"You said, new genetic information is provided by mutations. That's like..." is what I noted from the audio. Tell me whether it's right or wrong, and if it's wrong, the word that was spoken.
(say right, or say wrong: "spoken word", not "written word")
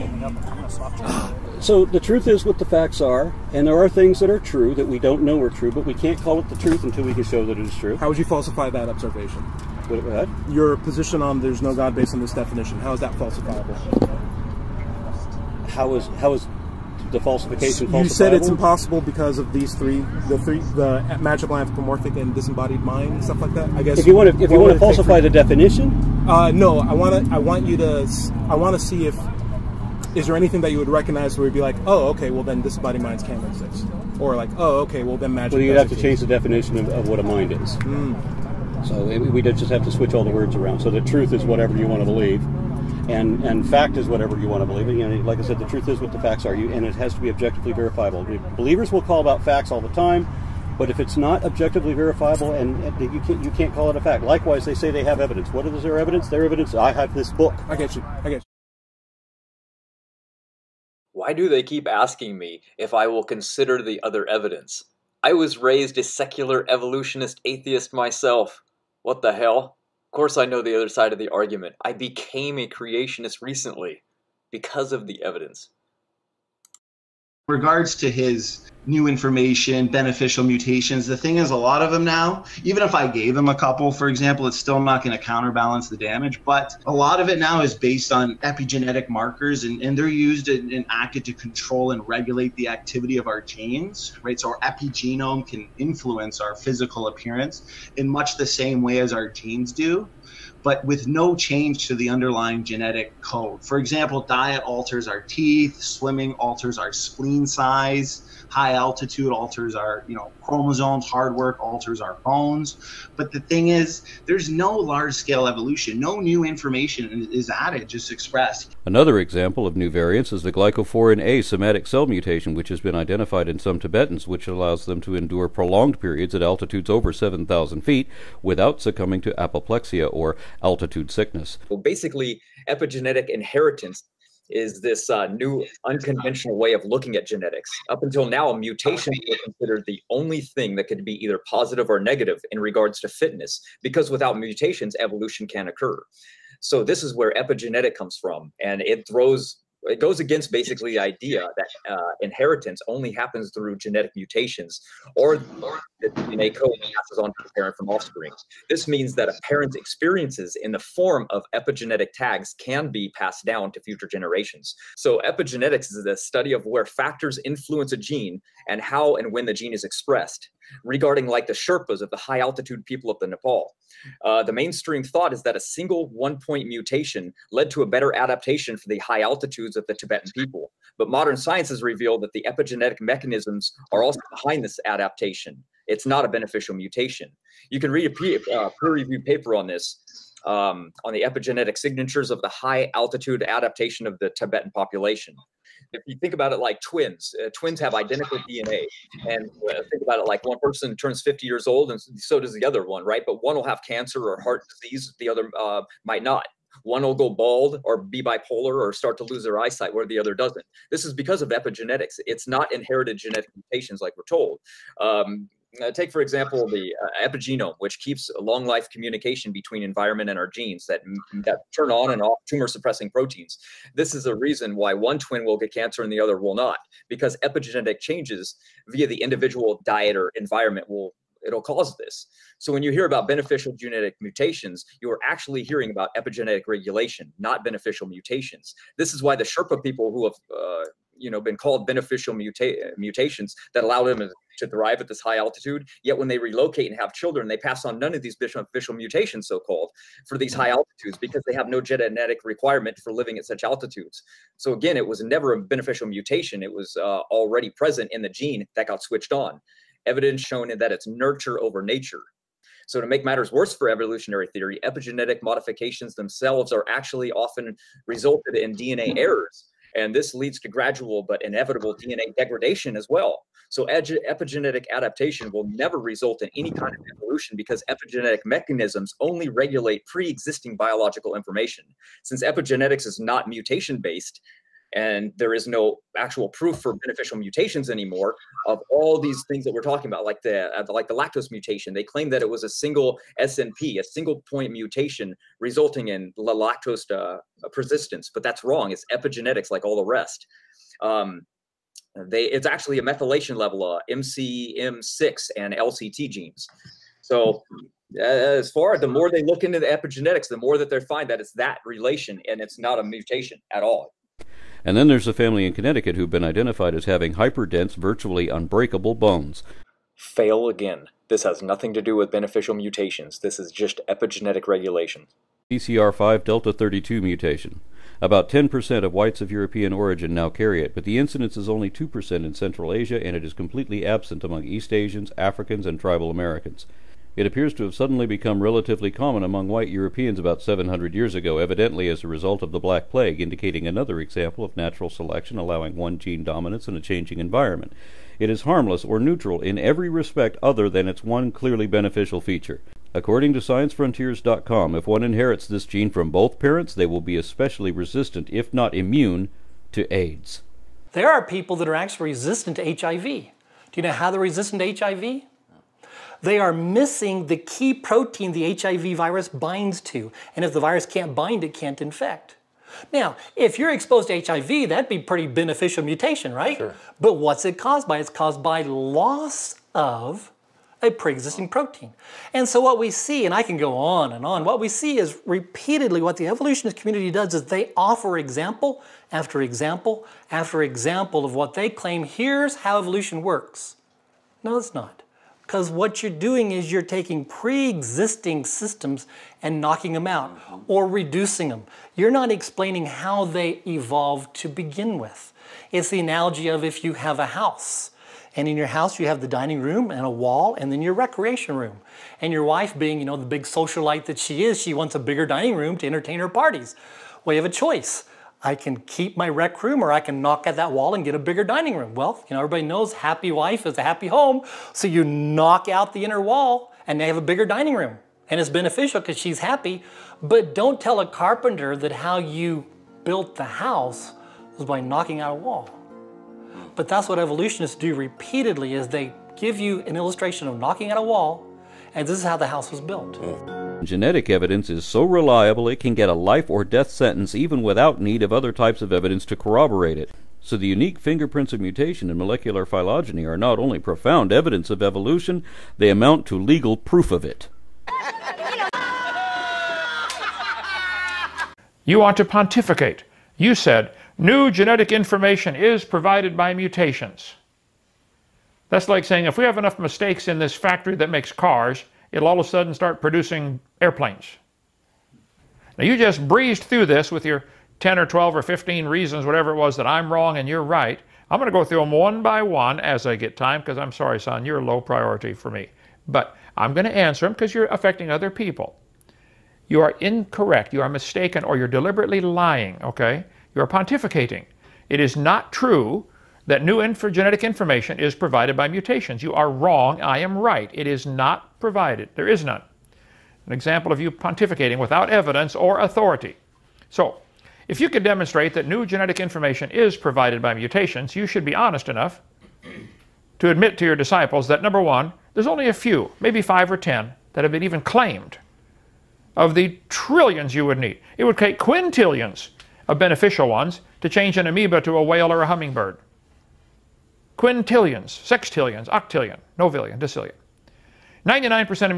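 right.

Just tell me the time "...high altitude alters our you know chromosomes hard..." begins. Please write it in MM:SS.
01:48.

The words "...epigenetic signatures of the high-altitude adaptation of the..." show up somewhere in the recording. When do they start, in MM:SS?
03:11.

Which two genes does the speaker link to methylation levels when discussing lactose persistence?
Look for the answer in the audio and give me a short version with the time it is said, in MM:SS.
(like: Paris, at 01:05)
MCM6 and LCT, at 05:04.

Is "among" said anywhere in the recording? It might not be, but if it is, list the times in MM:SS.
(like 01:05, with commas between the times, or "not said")
05:34, 05:39.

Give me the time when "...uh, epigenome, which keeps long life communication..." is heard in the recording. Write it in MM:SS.
03:37.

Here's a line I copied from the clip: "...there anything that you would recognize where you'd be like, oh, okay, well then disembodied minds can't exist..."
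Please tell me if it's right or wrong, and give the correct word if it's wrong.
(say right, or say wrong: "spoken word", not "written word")
right.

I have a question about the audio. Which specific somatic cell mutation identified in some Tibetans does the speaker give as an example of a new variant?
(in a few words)
glycophorin A.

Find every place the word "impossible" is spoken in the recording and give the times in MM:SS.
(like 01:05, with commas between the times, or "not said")
00:18.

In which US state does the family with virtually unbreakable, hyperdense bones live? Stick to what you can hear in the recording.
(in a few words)
Connecticut.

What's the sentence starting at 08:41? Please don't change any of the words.
It would take quintillions of beneficial ones to change an amoeba to a whale or a hummingbird quintillions, sextillions, octillion, novillion, decillion.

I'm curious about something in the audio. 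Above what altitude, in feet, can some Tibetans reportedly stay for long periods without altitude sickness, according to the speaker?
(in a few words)
7000 feet.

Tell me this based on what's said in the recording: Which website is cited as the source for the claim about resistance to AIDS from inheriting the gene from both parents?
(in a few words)
sciencefrontiers.com.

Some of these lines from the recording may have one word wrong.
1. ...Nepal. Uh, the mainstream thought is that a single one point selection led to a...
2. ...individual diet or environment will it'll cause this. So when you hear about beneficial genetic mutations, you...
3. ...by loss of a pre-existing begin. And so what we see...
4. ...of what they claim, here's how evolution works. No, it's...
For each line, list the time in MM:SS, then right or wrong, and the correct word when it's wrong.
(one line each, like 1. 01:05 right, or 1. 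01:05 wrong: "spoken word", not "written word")
1. 02:53 wrong: "mutation", not "selection"
2. 03:49 right
3. 06:18 wrong: "protein", not "begin"
4. 06:31 right.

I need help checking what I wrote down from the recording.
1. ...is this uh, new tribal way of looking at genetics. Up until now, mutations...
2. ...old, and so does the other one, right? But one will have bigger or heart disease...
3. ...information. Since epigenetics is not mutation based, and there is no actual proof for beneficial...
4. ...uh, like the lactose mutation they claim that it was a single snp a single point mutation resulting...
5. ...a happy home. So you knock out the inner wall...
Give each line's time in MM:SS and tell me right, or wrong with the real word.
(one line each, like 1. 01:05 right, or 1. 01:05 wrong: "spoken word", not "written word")
1. 02:14 wrong: "unconventional", not "tribal"
2. 03:21 wrong: "cancer", not "bigger"
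3. 04:41 right
4. 04:50 right
5. 07:03 right.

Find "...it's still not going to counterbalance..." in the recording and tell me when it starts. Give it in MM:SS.
01:24.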